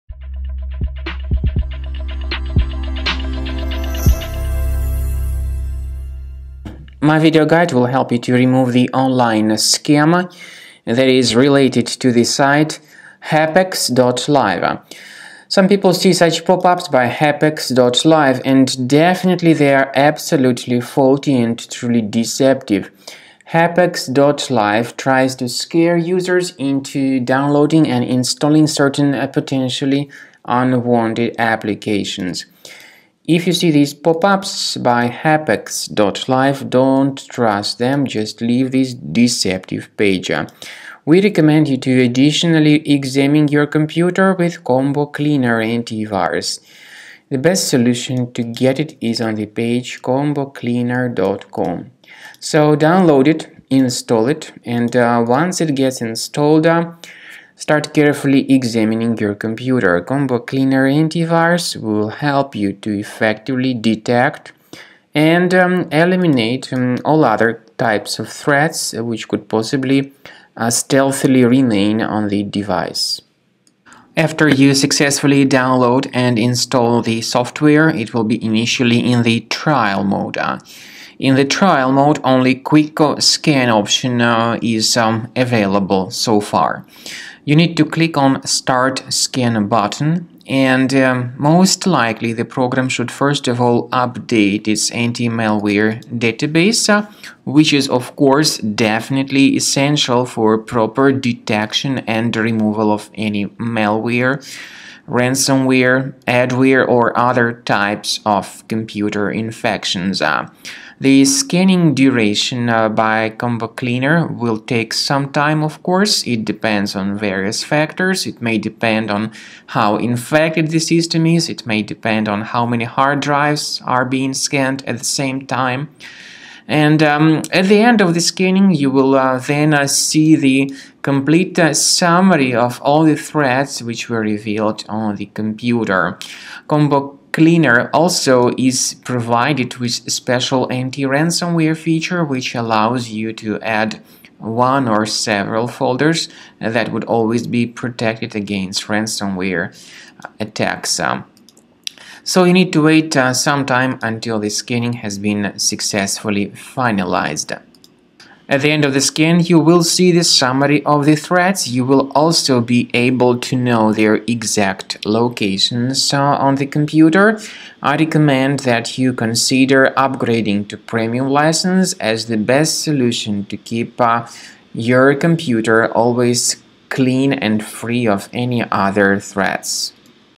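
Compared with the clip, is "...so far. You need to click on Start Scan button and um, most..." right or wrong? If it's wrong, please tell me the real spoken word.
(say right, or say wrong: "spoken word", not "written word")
right.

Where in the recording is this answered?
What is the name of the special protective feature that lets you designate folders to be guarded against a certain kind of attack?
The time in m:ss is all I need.
2:20.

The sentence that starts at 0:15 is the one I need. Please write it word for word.
Some people see such pop-ups by hapex.live and definitely they are absolutely faulty and truly deceptive.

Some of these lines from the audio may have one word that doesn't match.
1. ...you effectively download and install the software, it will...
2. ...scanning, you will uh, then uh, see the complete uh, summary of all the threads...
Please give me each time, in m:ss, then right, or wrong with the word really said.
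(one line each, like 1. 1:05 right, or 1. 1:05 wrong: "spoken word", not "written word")
1. 1:14 wrong: "successfully", not "effectively"
2. 2:08 right.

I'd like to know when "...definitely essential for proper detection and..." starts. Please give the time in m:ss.
1:38.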